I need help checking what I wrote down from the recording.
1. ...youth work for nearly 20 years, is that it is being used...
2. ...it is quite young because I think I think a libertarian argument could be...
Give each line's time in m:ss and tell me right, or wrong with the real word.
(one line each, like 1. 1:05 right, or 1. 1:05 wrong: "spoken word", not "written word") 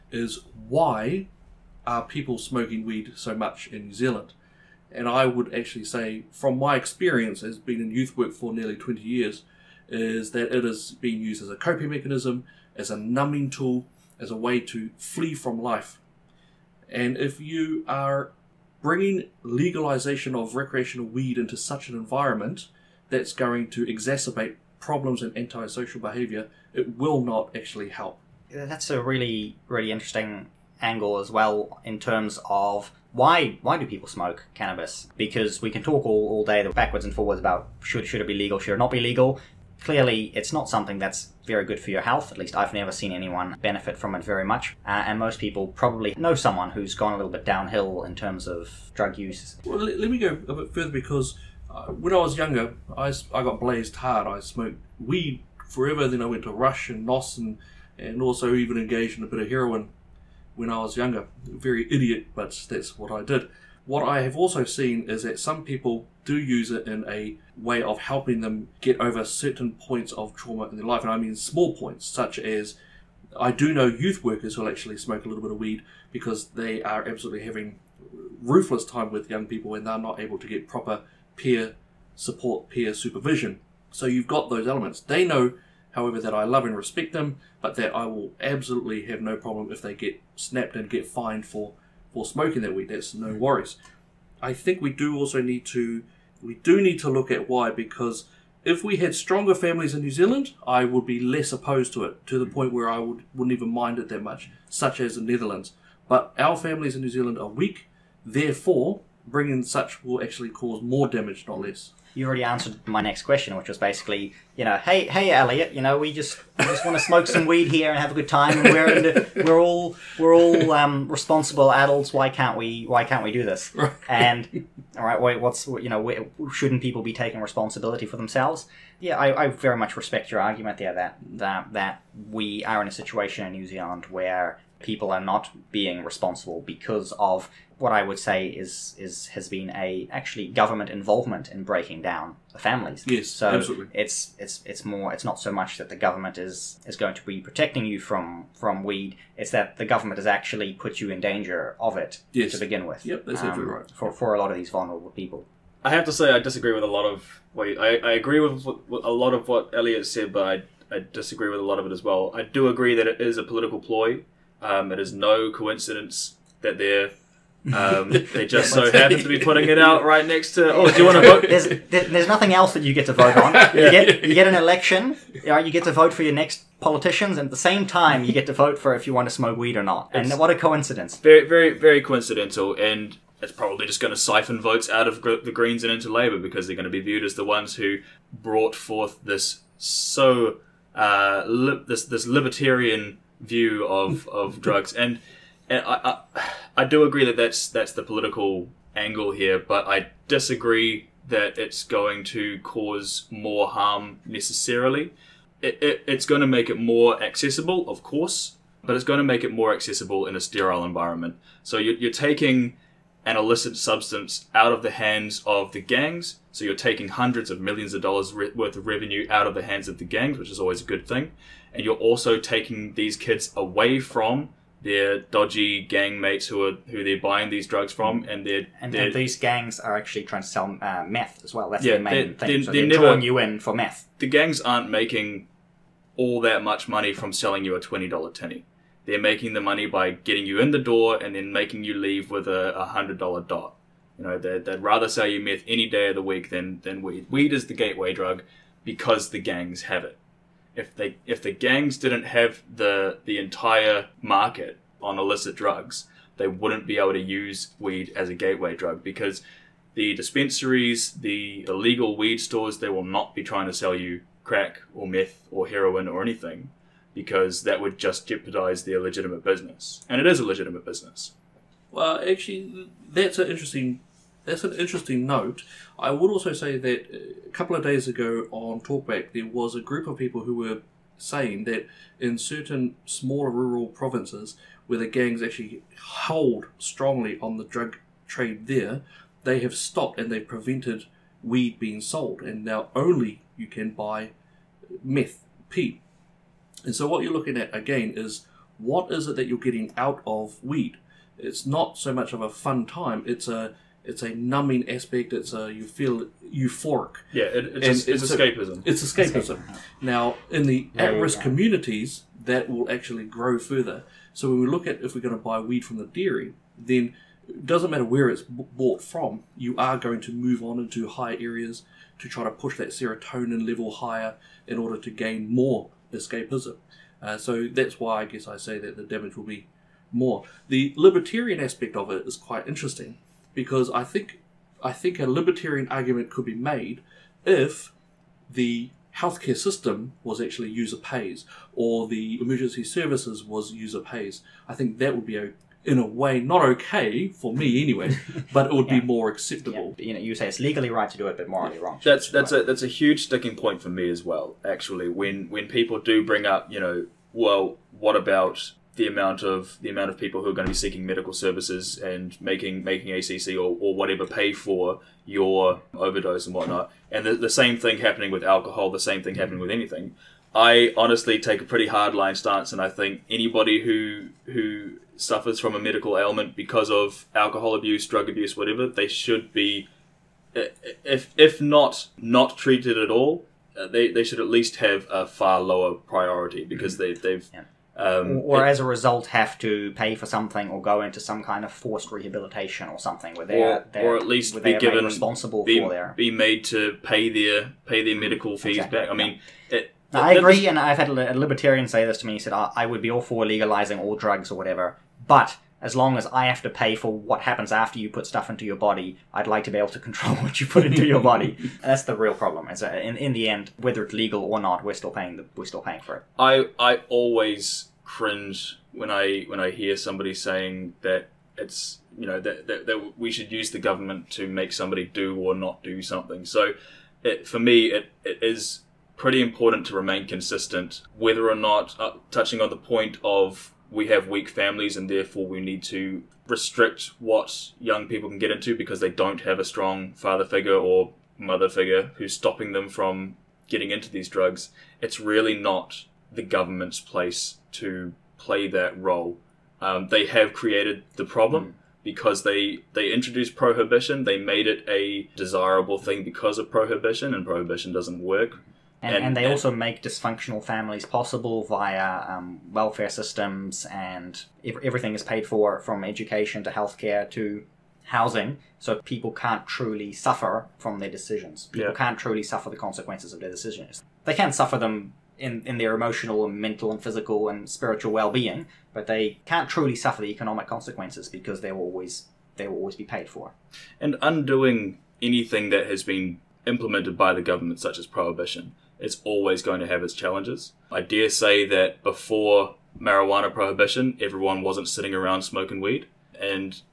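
1. 0:07 right
2. 5:32 wrong: "interesting", not "young".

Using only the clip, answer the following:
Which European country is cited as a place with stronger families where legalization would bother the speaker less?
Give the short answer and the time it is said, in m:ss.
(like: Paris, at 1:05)
Netherlands, at 1:45.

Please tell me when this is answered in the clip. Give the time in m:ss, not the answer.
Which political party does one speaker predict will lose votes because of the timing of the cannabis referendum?
3:05.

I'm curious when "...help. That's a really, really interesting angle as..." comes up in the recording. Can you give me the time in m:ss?
0:27.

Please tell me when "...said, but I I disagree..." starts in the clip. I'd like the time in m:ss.
2:40.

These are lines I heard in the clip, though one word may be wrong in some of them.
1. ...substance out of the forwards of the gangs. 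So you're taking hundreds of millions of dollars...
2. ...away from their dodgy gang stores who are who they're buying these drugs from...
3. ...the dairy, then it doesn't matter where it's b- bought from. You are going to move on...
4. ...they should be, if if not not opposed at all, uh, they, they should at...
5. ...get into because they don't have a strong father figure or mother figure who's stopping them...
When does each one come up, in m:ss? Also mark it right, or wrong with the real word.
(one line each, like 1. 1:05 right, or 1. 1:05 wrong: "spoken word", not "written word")
1. 3:33 wrong: "hands", not "forwards"
2. 3:43 wrong: "mates", not "stores"
3. 5:15 right
4. 6:18 wrong: "treated", not "opposed"
5. 7:18 right.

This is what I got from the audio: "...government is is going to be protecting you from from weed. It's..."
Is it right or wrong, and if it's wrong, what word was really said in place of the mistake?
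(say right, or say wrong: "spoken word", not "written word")
right.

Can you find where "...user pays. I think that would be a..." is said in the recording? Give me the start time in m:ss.
5:43.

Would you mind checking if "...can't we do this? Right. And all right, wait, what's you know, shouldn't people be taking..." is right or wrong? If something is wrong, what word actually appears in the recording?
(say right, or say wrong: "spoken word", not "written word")
right.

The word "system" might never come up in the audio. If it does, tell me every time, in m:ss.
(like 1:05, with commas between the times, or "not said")
5:39, 7:43.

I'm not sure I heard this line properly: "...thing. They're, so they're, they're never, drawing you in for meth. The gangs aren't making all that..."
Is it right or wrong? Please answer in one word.
right.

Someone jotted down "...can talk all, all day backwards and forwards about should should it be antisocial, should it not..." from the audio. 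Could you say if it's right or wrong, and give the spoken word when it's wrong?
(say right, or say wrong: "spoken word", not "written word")
wrong: "legal", not "antisocial".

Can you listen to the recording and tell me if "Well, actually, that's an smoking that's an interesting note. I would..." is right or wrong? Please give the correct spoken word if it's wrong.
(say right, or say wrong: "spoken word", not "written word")
wrong: "interesting", not "smoking".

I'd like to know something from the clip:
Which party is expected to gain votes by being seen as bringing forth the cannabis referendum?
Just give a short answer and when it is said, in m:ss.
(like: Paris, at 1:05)
Labour, at 3:06.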